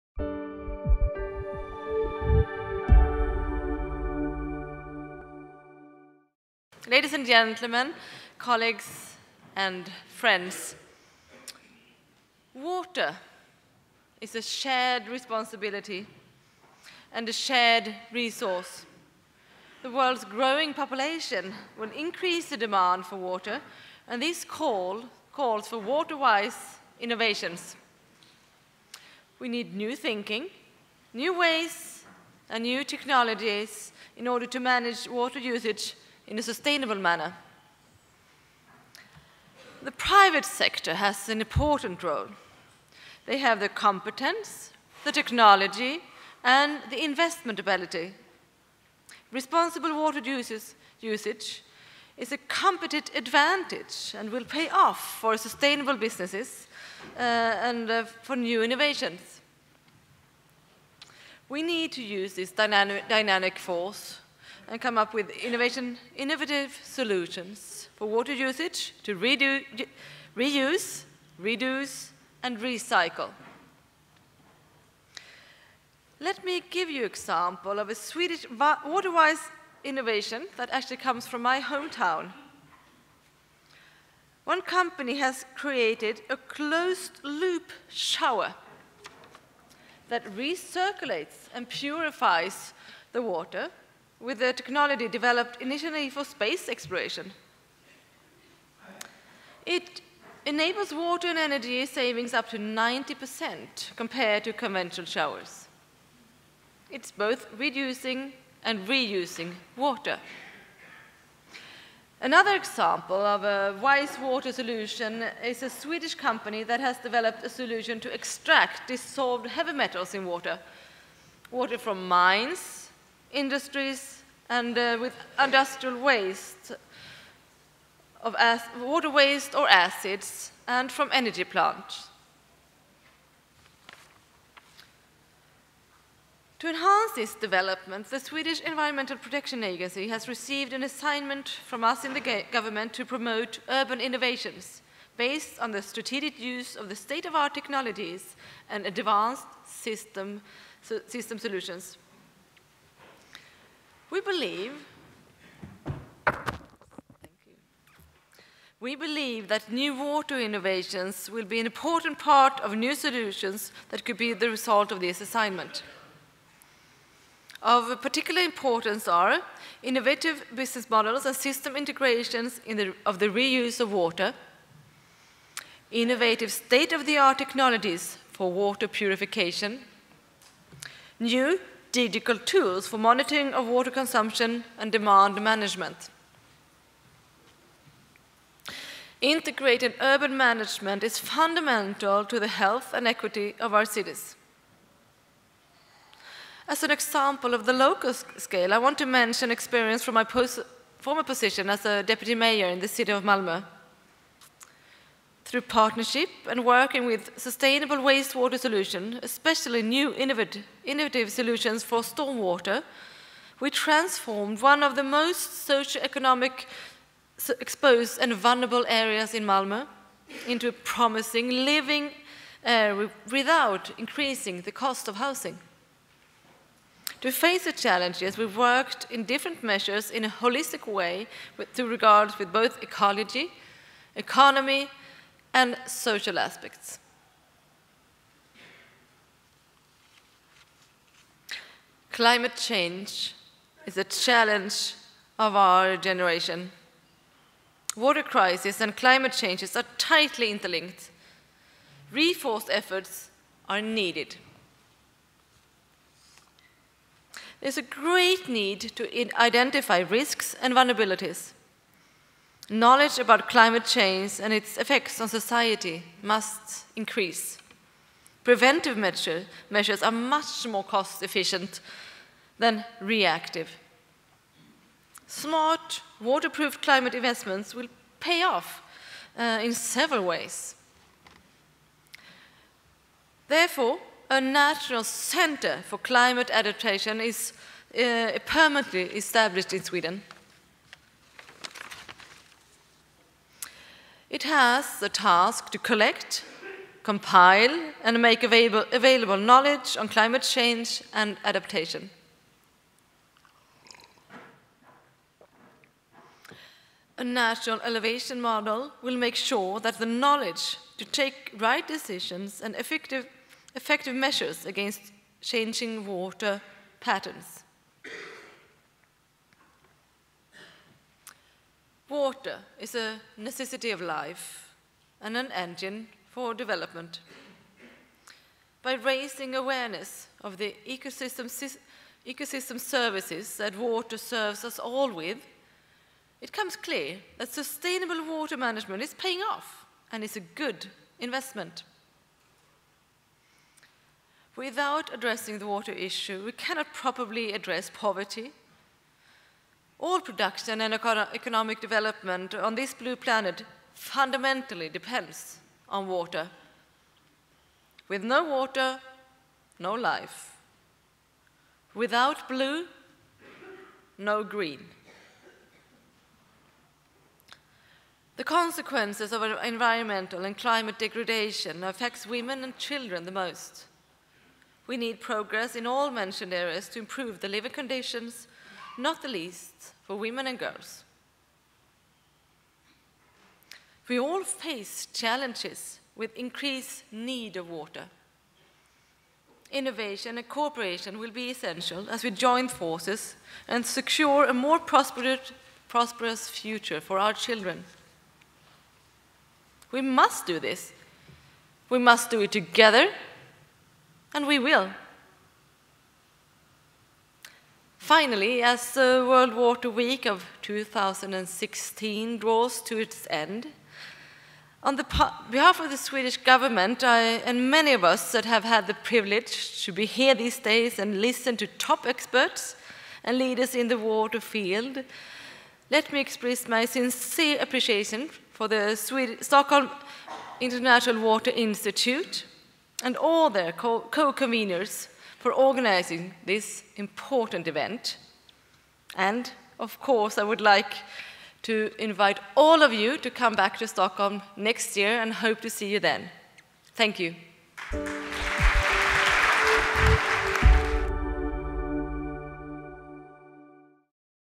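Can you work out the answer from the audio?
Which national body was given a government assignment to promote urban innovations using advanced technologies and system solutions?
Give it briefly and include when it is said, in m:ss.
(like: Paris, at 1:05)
Swedish Environmental Protection Agency, at 2:18.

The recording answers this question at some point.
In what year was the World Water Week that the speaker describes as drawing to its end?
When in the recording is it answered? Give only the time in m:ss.
6:50.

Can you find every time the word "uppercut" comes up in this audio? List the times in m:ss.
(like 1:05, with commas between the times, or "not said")
not said.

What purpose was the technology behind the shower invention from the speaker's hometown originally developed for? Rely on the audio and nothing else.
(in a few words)
Space exploration.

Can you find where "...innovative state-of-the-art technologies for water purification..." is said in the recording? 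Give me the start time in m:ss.
2:55.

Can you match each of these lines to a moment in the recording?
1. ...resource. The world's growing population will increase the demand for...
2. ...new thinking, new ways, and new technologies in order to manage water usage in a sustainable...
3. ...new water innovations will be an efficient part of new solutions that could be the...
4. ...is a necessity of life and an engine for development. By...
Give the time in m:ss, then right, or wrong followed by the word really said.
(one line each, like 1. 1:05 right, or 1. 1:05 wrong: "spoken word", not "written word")
1. 0:18 right
2. 0:29 right
3. 2:39 wrong: "important", not "efficient"
4. 5:22 right.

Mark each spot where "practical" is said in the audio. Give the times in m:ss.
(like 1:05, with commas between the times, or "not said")
not said.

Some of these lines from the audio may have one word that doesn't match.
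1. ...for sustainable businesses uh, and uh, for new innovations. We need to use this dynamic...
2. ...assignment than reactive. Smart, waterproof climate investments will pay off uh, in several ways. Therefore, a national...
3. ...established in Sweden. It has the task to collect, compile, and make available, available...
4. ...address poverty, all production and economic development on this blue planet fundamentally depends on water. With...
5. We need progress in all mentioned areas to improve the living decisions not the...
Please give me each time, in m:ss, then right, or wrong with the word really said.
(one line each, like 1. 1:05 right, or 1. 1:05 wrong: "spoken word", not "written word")
1. 0:55 right
2. 4:31 wrong: "efficient", not "assignment"
3. 4:49 right
4. 5:47 right
5. 6:14 wrong: "conditions", not "decisions".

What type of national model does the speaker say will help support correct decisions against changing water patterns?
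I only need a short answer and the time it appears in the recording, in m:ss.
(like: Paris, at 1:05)
National elevation model, at 5:07.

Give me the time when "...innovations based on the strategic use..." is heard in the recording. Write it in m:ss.
2:23.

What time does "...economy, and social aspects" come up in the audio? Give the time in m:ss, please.
3:54.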